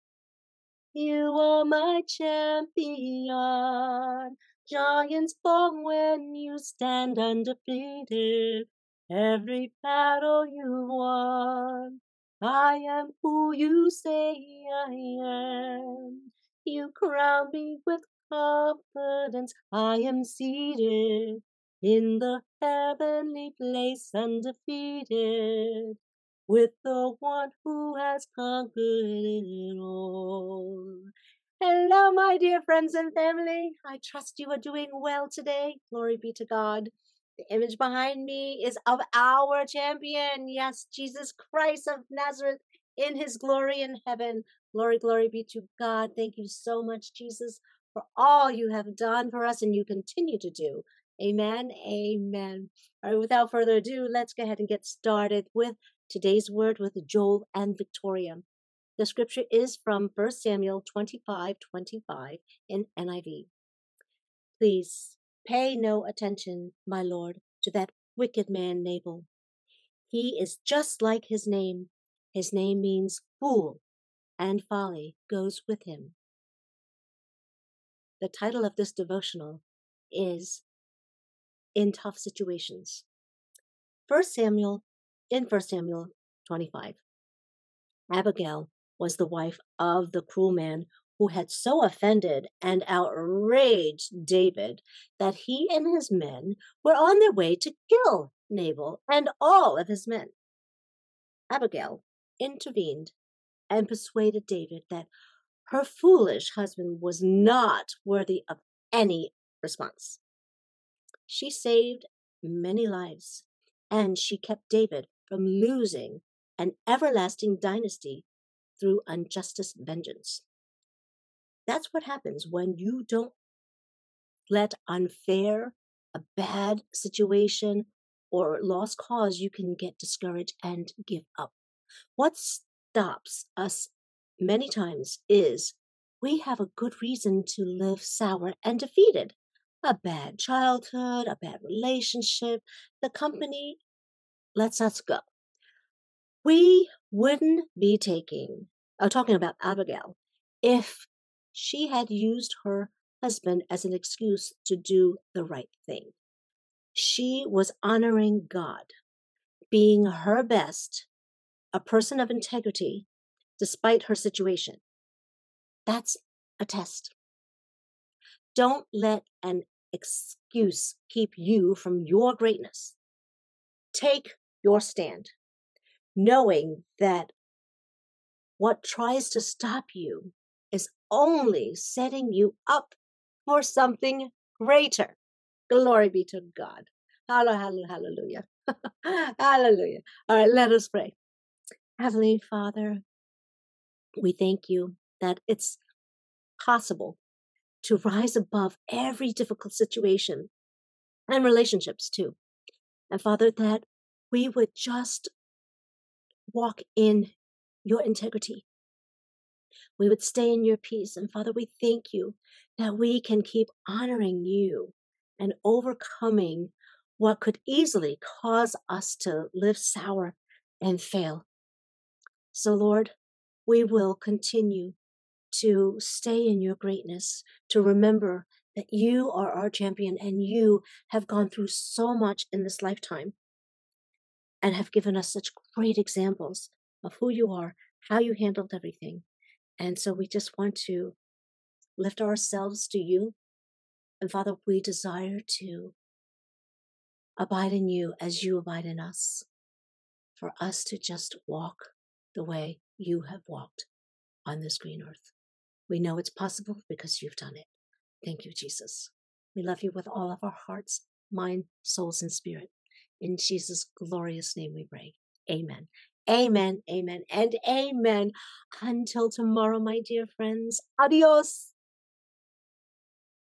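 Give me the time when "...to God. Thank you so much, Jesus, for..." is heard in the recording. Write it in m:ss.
0:45.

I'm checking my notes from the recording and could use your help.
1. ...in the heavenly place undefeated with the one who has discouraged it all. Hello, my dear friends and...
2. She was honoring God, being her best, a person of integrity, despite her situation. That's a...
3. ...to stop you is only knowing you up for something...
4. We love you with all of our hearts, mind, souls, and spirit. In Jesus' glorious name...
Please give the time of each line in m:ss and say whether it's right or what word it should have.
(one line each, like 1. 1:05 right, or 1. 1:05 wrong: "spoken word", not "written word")
1. 0:21 wrong: "conquered", not "discouraged"
2. 2:36 right
3. 2:59 wrong: "setting", not "knowing"
4. 4:19 right.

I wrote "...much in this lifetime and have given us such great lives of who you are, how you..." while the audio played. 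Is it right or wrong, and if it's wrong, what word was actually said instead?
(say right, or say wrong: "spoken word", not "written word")
wrong: "examples", not "lives".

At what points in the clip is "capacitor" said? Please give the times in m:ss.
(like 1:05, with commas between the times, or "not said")
not said.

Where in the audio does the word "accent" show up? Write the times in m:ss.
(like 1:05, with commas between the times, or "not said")
not said.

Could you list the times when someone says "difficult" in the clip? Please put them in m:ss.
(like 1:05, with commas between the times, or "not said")
3:19.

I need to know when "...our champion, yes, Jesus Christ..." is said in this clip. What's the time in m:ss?
0:39.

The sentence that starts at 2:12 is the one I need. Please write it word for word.
What stops us many times is we have a good reason to live sour and defeated.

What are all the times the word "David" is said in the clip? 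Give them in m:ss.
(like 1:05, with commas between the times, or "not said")
1:34, 1:44, 1:54.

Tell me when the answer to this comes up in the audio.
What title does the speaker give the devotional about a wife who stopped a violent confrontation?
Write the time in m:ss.
1:21.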